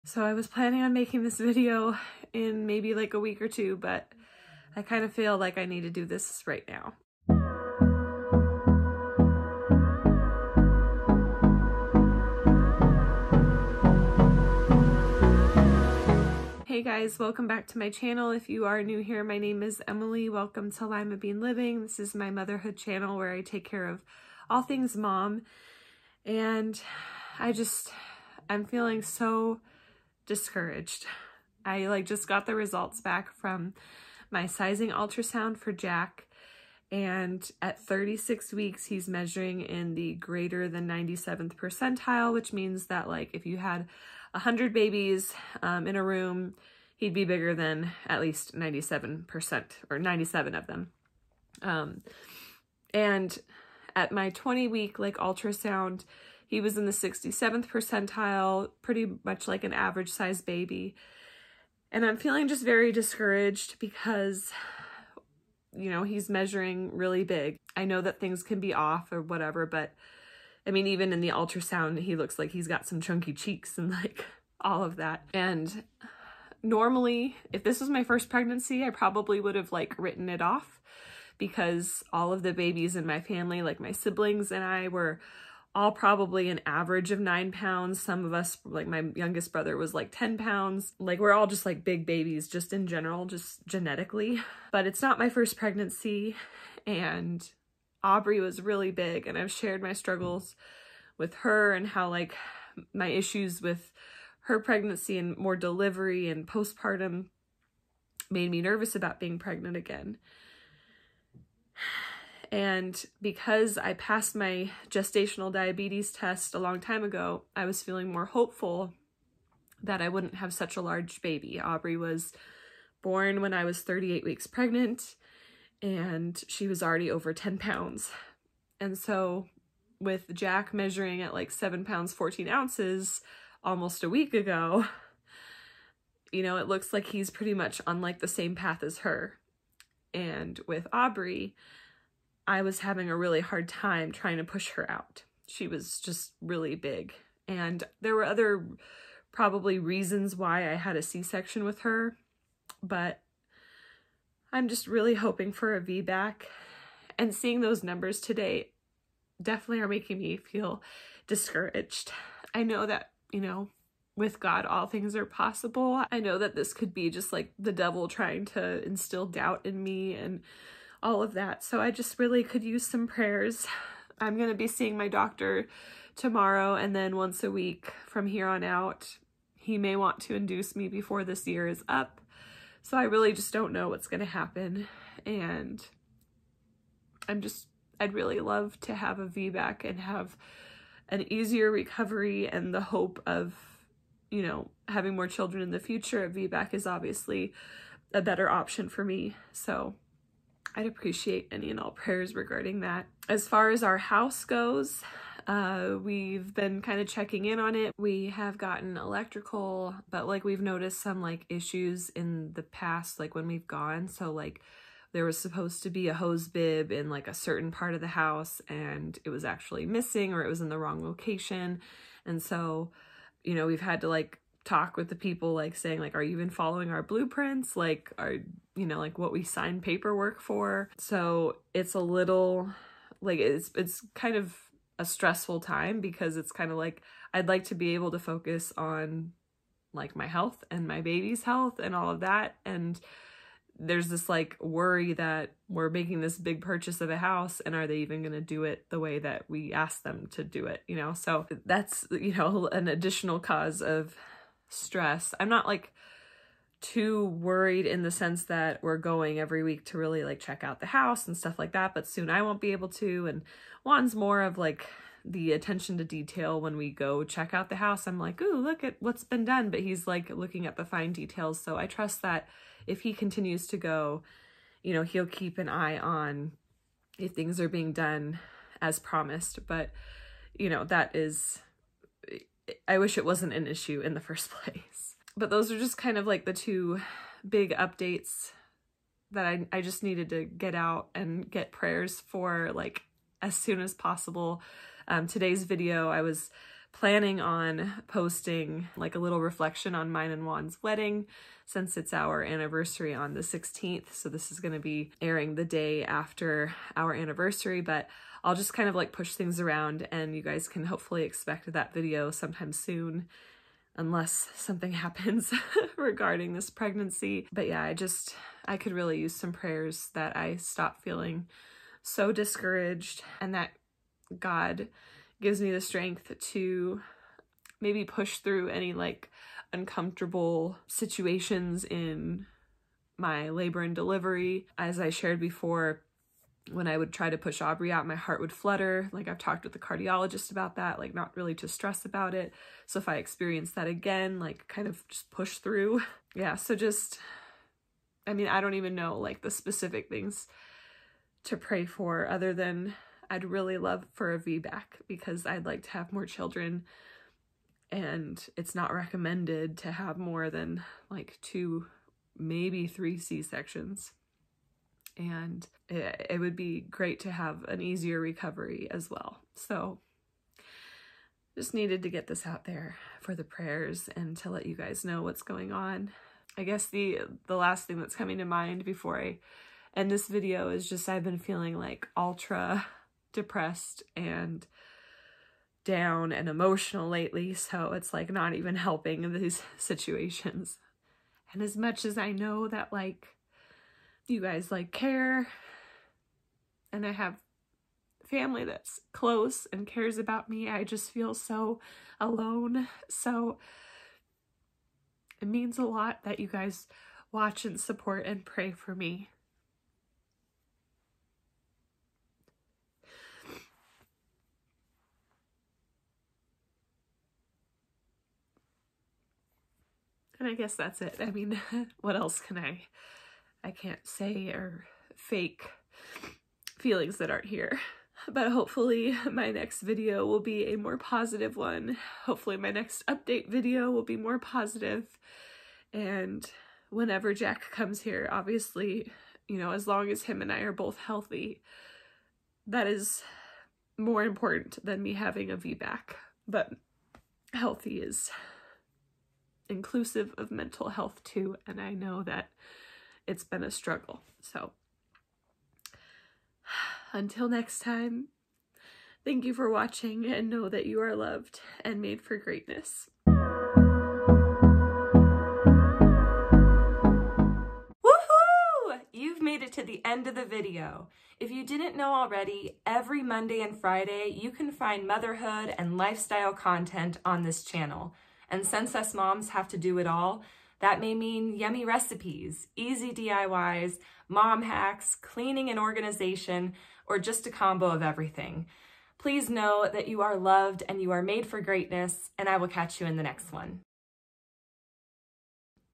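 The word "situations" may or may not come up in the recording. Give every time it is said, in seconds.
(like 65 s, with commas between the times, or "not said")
330 s, 389 s.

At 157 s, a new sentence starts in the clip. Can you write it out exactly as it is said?
And seeing those numbers today definitely are making me feel discouraged.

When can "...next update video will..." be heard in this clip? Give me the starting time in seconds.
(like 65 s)
432 s.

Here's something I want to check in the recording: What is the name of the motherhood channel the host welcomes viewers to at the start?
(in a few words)
Limabean Living.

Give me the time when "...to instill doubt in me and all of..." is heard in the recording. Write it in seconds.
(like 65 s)
168 s.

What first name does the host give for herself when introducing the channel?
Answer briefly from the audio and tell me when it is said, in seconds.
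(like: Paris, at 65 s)
Emily, at 19 s.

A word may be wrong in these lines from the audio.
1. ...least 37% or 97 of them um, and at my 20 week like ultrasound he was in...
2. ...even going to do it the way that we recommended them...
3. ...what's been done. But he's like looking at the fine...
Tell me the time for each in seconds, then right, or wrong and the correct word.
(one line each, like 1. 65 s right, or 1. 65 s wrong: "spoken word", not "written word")
1. 48 s wrong: "97", not "37"
2. 247 s wrong: "asked", not "recommended"
3. 268 s right.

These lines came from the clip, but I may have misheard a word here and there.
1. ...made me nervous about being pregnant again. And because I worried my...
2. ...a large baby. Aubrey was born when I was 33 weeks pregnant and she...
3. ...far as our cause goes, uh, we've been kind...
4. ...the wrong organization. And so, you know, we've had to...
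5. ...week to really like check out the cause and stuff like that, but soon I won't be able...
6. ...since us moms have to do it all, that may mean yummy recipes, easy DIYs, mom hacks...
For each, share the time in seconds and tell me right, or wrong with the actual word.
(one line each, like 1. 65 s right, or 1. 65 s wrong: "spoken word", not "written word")
1. 108 s wrong: "passed", not "worried"
2. 120 s wrong: "38", not "33"
3. 203 s wrong: "house", not "cause"
4. 220 s wrong: "location", not "organization"
5. 259 s wrong: "house", not "cause"
6. 478 s right.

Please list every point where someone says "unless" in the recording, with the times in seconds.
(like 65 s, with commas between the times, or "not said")
313 s.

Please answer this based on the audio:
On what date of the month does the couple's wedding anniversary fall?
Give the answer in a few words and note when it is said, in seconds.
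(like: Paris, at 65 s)
16th, at 303 s.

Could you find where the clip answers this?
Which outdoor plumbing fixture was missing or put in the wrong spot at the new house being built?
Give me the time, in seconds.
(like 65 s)
216 s.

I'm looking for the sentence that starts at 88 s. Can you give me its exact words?
Some of us, like my youngest brother was like 10 pounds.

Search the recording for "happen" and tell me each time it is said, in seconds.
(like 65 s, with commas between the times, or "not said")
184 s, 314 s.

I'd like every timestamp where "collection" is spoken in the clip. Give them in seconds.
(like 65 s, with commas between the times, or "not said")
not said.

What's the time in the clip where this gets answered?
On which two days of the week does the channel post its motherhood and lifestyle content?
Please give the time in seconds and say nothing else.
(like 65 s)
473 s.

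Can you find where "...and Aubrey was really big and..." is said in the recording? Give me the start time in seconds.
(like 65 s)
96 s.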